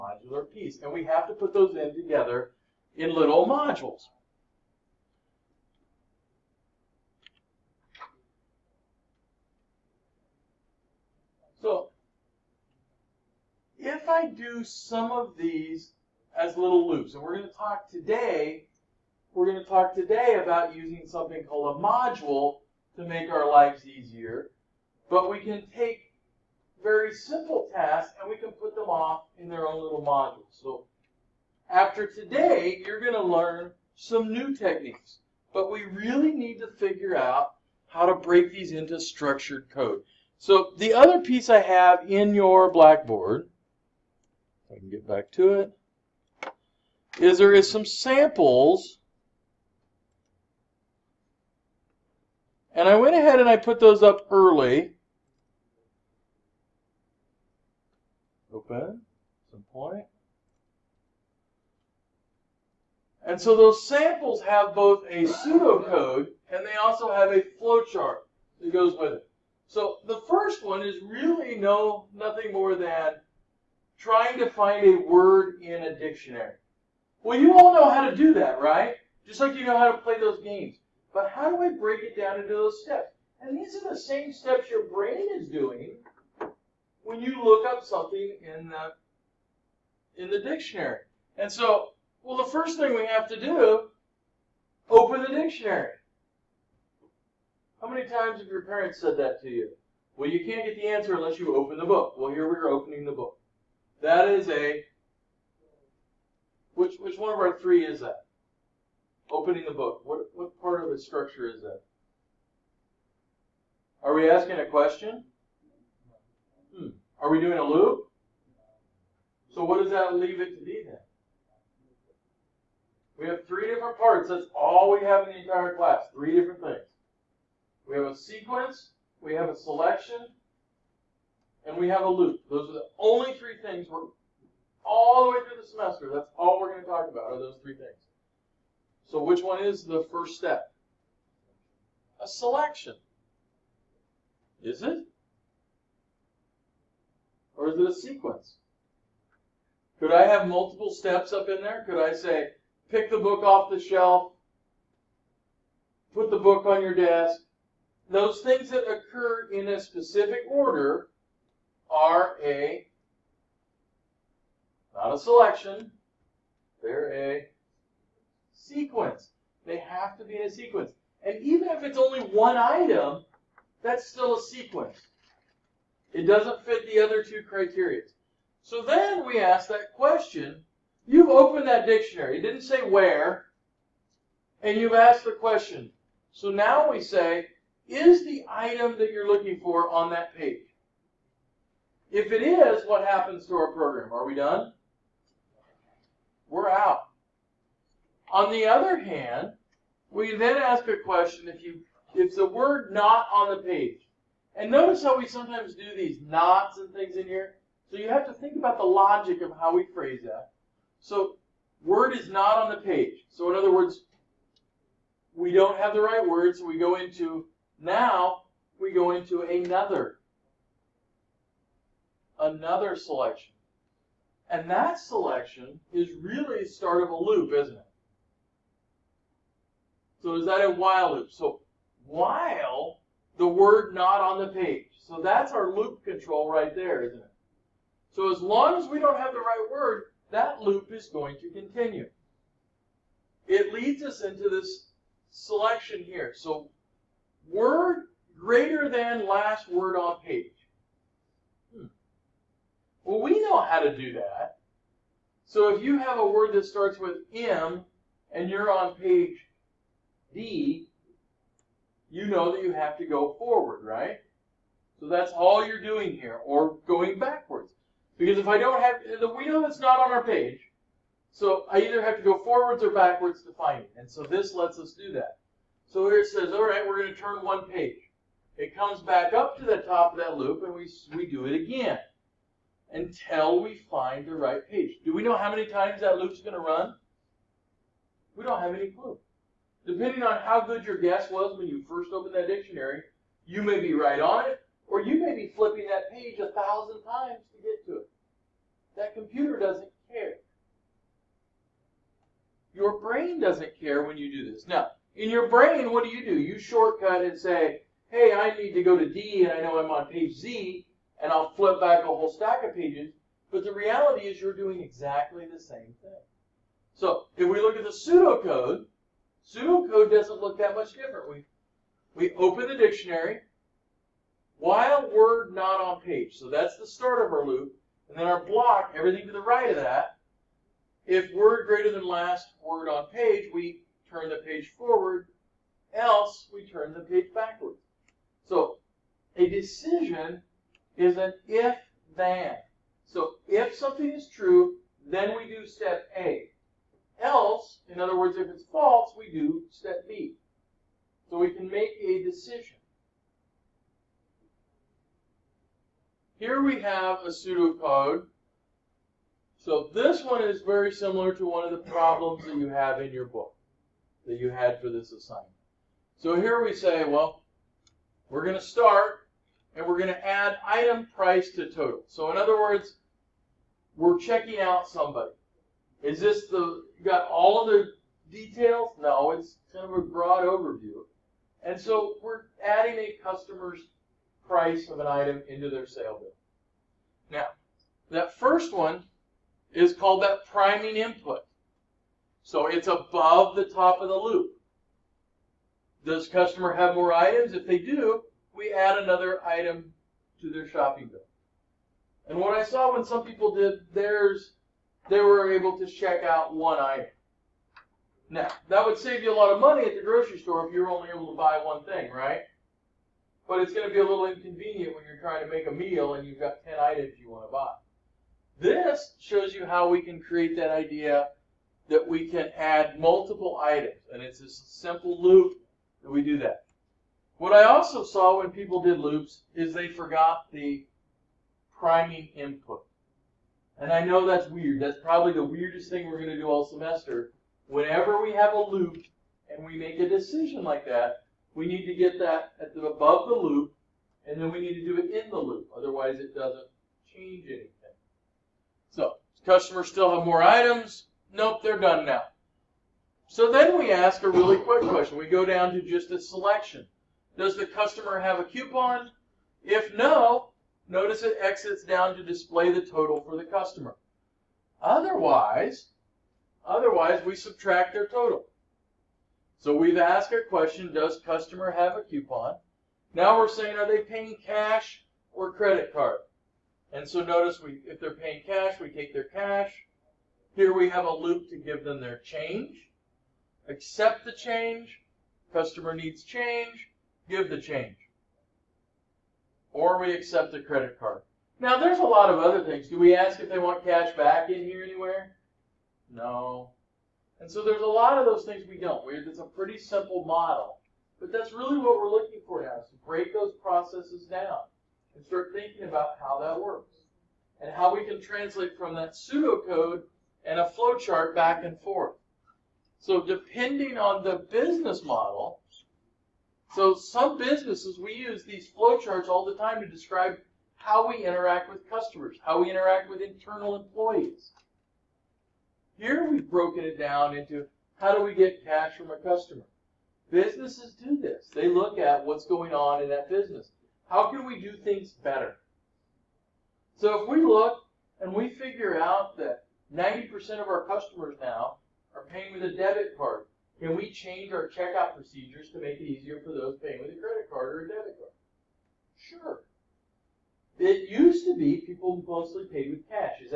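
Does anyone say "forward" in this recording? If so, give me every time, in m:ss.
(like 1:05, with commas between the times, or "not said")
4:23, 4:32, 5:34.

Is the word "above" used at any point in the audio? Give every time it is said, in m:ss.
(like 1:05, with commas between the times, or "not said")
6:32, 7:22.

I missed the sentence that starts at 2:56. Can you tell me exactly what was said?
It doesn't fit the other two criteria.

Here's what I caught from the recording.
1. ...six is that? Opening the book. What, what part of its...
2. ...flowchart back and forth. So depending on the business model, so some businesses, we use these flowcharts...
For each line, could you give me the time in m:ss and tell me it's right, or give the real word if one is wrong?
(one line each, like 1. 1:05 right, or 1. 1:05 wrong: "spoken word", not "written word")
1. 1:47 wrong: "three", not "six"
2. 8:30 right.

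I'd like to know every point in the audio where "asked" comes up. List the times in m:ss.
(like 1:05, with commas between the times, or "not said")
3:04, 7:49.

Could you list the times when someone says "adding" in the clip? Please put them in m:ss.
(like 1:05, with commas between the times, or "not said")
6:22.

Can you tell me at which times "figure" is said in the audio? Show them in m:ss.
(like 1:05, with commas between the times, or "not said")
0:36, 8:58.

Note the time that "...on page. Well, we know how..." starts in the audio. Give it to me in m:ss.
4:09.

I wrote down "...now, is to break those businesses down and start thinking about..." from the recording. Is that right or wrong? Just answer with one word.
wrong.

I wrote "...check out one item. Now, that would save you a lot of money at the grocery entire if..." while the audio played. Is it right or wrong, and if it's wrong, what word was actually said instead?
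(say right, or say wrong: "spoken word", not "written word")
wrong: "store", not "entire".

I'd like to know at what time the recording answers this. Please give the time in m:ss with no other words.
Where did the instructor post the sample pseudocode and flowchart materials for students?
0:42.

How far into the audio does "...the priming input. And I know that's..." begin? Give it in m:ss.
7:10.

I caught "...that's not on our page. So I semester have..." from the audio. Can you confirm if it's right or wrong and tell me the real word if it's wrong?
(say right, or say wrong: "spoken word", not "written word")
wrong: "either", not "semester".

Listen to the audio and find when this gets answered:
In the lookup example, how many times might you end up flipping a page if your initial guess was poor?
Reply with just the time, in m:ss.
4:56.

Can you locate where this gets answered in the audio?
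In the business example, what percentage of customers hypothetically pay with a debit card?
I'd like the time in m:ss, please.
8:59.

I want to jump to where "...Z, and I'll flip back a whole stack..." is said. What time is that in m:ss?
5:10.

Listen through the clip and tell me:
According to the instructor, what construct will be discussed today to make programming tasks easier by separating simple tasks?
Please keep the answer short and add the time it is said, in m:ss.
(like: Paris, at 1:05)
Module, at 0:21.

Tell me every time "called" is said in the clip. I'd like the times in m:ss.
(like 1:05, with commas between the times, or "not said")
0:21, 6:29.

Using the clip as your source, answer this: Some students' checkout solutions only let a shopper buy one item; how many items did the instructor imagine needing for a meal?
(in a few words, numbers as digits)
10.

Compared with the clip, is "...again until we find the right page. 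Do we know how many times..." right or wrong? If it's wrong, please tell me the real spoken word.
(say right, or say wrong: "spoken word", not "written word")
right.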